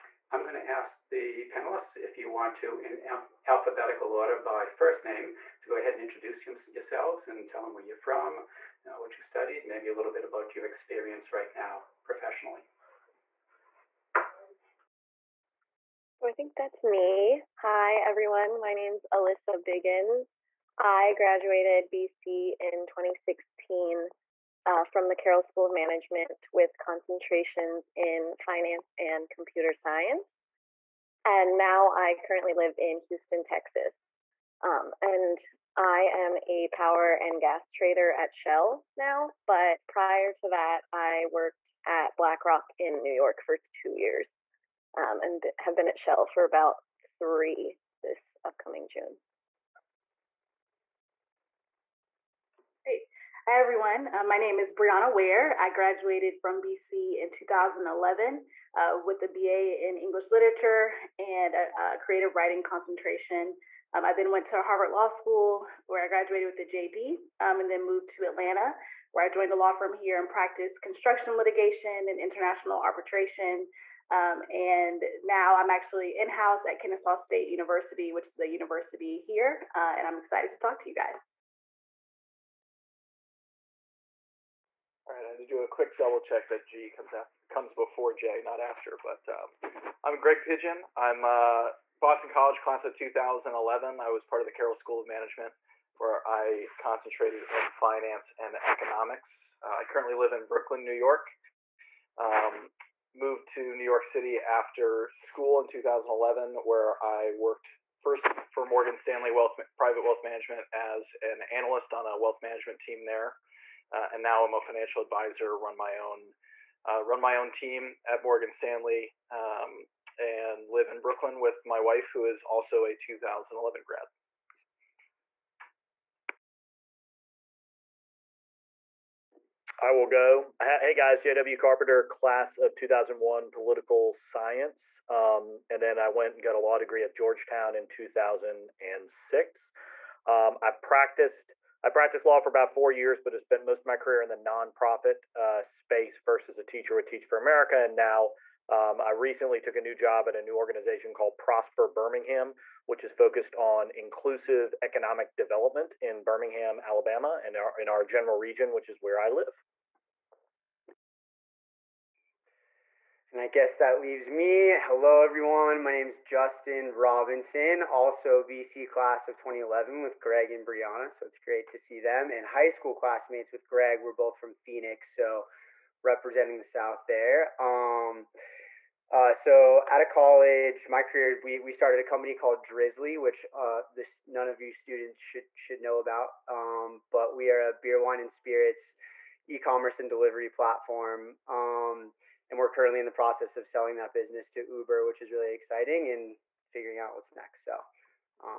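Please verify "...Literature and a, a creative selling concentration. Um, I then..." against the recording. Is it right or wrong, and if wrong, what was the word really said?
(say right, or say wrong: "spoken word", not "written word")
wrong: "writing", not "selling".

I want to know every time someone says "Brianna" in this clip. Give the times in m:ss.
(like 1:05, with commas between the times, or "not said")
0:54, 2:50.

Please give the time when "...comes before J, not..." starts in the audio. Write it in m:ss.
1:27.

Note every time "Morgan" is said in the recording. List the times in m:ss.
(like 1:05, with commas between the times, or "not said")
1:48, 1:58.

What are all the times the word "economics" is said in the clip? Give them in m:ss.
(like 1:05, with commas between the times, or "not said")
1:38, 2:34.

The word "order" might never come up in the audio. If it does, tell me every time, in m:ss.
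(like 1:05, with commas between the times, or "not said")
0:04.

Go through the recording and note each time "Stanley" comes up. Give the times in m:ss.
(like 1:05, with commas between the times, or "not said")
1:48, 1:58.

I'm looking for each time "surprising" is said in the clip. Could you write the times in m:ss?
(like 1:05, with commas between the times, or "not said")
not said.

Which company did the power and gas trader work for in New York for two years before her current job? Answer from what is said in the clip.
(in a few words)
BlackRock.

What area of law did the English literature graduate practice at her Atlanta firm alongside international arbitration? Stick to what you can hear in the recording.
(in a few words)
Construction litigation.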